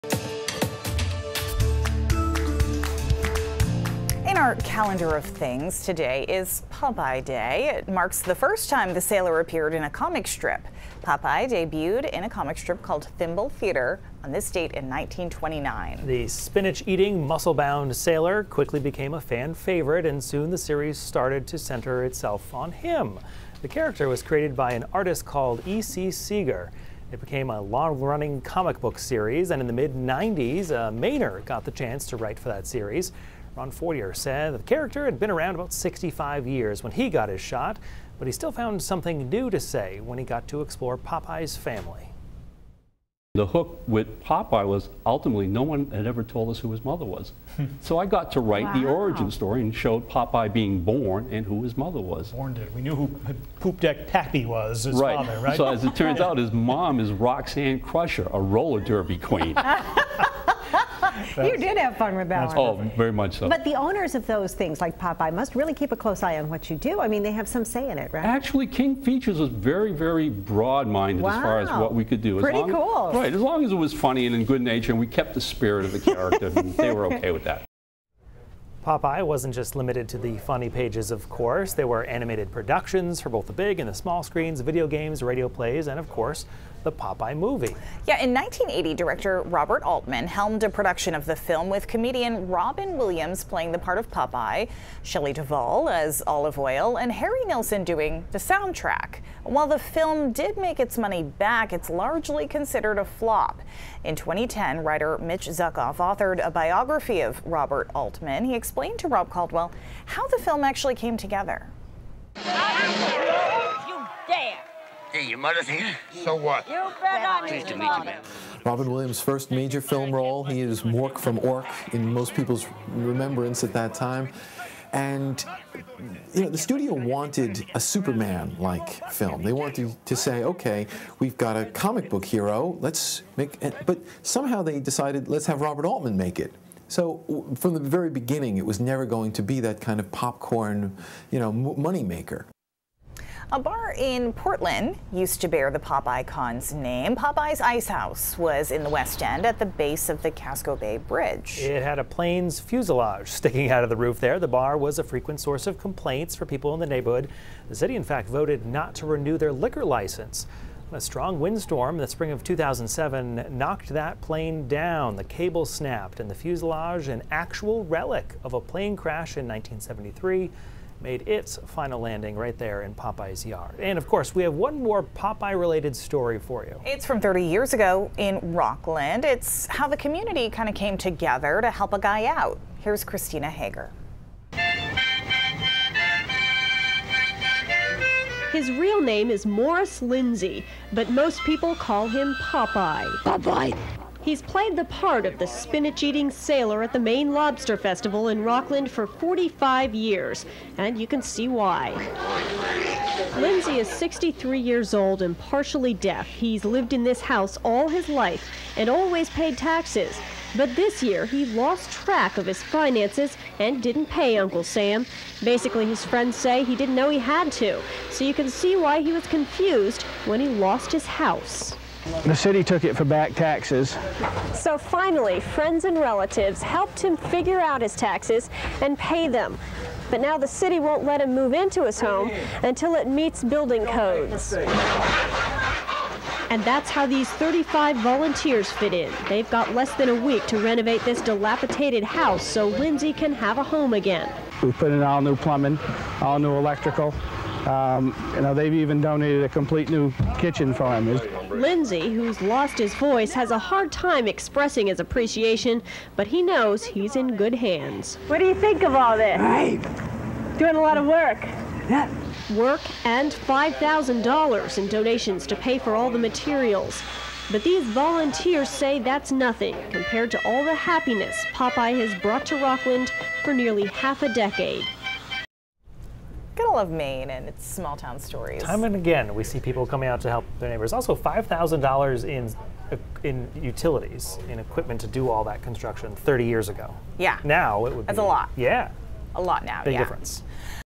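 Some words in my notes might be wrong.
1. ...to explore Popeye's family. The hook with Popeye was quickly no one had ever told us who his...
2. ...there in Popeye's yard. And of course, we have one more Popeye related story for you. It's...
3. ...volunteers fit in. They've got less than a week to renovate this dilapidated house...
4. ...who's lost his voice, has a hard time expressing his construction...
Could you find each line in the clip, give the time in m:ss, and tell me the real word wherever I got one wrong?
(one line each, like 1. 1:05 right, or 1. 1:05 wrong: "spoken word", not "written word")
1. 0:40 wrong: "ultimately", not "quickly"
2. 2:52 right
3. 3:57 right
4. 4:12 wrong: "appreciation", not "construction".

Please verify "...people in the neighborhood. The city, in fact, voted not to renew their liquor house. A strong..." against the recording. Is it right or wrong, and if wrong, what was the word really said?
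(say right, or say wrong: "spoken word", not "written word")
wrong: "license", not "house".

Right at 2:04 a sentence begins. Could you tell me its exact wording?
And you know, the studio wanted a Superman-like film.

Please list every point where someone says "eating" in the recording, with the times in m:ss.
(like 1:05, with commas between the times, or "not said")
0:16, 3:16.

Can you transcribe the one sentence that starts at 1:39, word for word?
While the film did make its money back, it's largely considered a flop.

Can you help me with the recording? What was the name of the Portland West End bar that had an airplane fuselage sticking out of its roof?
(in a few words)
Popeye's Ice House.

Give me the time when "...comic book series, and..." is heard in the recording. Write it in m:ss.
0:28.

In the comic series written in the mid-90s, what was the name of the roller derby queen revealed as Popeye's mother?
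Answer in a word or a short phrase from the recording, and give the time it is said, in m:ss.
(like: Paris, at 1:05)
Roxanne Crusher, at 0:57.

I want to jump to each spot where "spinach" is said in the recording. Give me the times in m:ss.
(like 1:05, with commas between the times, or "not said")
0:16, 3:15.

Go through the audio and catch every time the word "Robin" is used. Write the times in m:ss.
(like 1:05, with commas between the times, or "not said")
1:32, 1:58.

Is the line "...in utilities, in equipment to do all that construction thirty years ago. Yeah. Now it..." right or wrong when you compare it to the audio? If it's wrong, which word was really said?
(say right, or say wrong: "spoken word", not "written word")
right.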